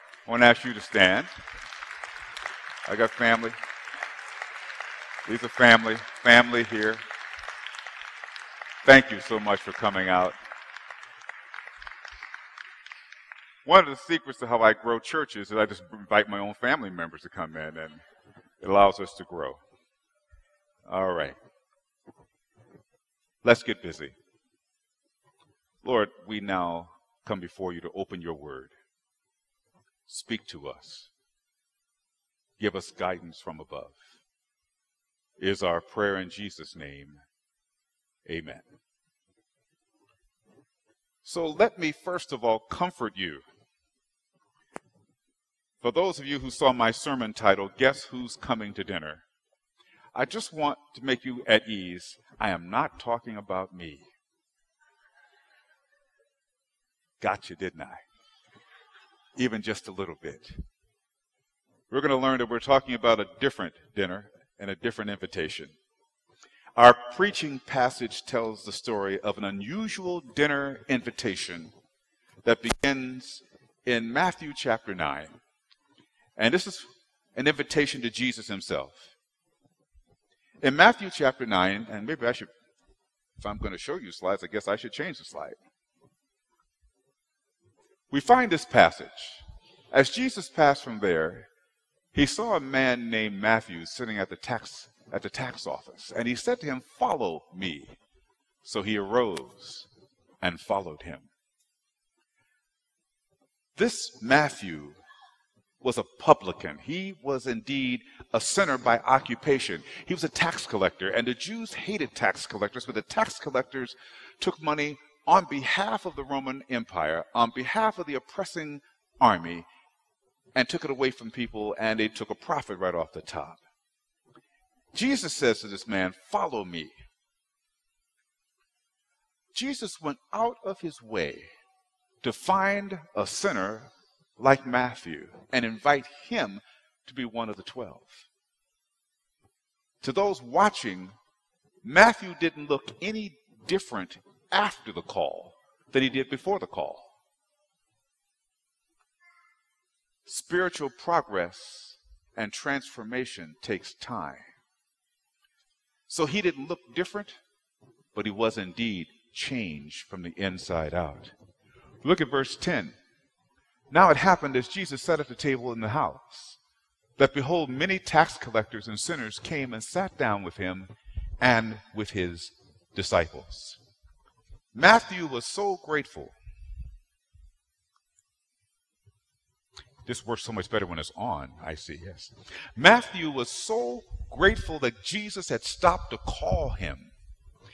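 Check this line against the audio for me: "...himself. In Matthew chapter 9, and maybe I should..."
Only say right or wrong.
right.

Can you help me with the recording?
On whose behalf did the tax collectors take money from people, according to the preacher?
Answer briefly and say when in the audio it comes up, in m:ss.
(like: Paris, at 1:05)
Roman Empire, at 1:56.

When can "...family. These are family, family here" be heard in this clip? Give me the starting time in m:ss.
0:03.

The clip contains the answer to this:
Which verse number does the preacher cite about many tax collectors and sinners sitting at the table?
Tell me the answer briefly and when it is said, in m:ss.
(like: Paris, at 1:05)
10, at 2:42.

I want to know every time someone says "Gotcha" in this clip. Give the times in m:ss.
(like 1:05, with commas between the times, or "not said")
0:57.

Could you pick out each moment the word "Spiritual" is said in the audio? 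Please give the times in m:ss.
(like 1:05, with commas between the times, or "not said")
2:30.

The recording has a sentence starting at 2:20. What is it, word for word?
To those watching, Matthew didn't look any different after the call than he did before the call.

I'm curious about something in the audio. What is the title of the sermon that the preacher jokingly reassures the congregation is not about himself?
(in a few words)
Guess Who's Coming to Dinner?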